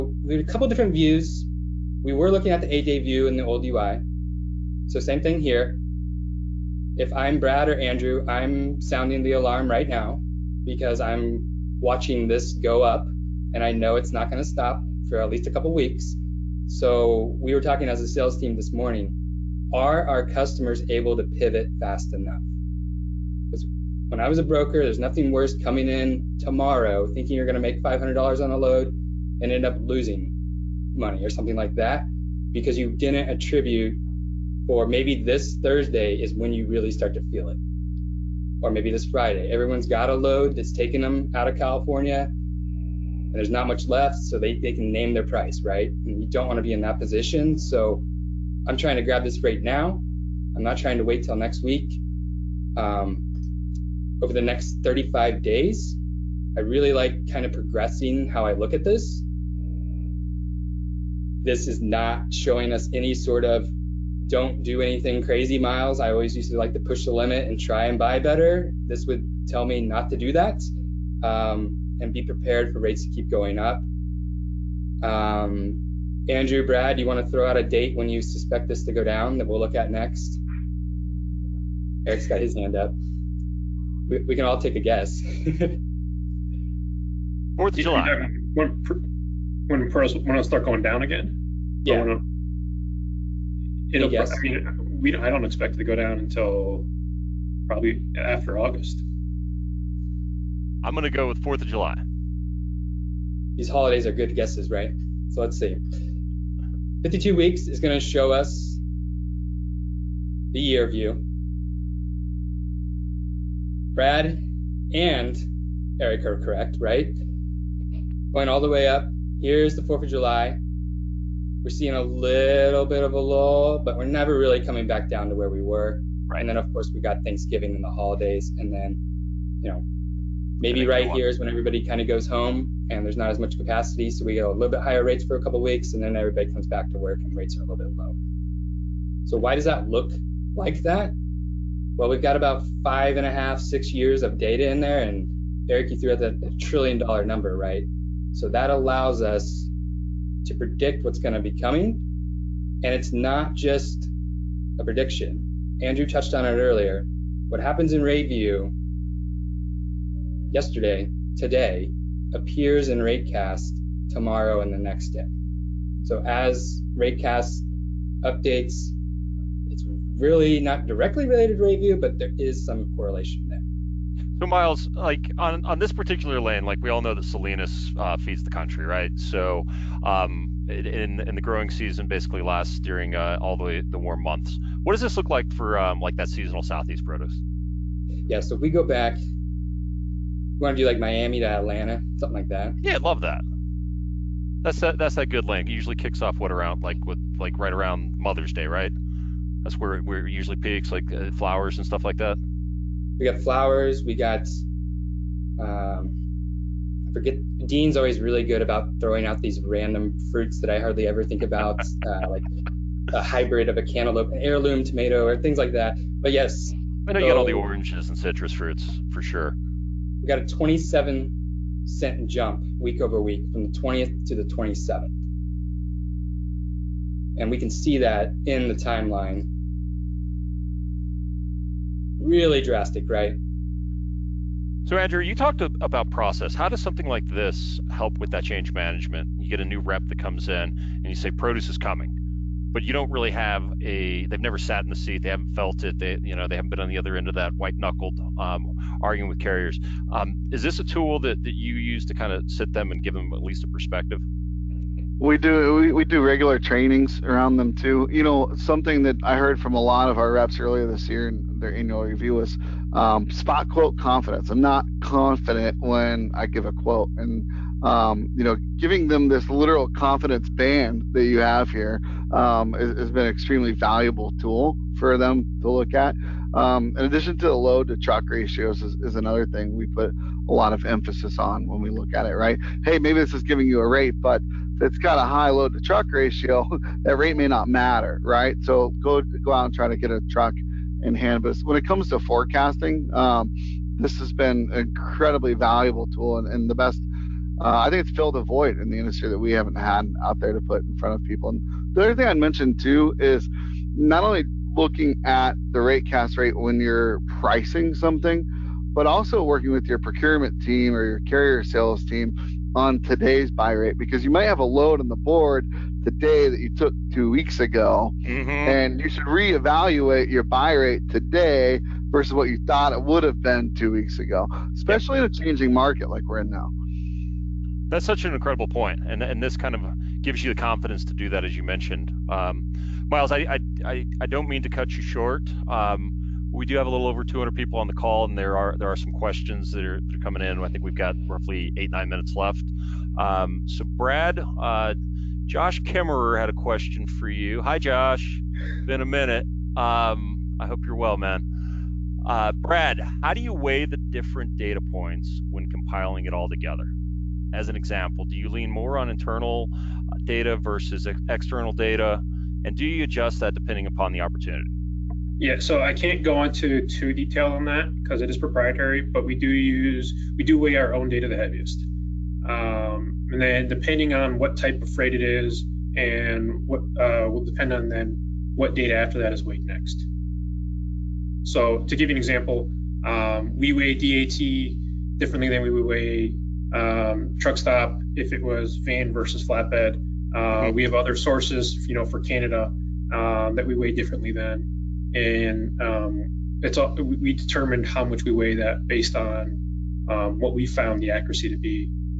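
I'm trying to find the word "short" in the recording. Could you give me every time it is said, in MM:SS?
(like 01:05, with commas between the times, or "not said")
05:35.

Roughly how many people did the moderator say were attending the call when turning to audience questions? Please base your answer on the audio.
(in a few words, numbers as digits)
Over 200.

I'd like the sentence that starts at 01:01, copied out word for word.
This is not showing us any sort of don't do anything crazy miles.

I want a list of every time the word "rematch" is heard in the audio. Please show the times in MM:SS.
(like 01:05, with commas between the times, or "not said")
not said.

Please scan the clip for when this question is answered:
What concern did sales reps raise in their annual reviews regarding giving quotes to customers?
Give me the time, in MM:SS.
04:23.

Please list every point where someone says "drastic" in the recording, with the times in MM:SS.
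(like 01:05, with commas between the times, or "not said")
03:52.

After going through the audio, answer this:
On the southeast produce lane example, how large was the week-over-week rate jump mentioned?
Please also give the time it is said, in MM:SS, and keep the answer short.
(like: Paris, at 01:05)
27 cents, at 03:40.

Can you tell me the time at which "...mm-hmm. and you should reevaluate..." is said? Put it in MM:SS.
05:18.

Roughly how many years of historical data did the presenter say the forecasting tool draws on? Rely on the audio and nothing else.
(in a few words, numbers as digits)
5.5 to 6 years.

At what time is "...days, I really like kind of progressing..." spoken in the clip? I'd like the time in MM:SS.
00:55.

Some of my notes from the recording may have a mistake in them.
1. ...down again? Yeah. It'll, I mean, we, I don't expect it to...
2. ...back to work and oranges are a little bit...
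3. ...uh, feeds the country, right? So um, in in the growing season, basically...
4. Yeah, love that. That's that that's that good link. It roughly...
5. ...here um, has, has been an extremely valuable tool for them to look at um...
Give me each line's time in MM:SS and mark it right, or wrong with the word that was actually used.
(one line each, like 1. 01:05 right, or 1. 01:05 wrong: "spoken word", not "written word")
1. 01:30 right
2. 02:16 wrong: "rates", not "oranges"
3. 02:57 right
4. 03:12 wrong: "usually", not "roughly"
5. 04:31 right.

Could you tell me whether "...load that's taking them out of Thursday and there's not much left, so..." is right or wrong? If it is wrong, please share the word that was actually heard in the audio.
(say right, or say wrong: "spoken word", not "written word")
wrong: "California", not "Thursday".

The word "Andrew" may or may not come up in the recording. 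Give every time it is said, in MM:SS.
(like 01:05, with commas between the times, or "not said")
00:07, 01:16, 02:35, 03:54.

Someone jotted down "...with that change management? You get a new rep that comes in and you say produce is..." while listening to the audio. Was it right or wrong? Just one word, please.
right.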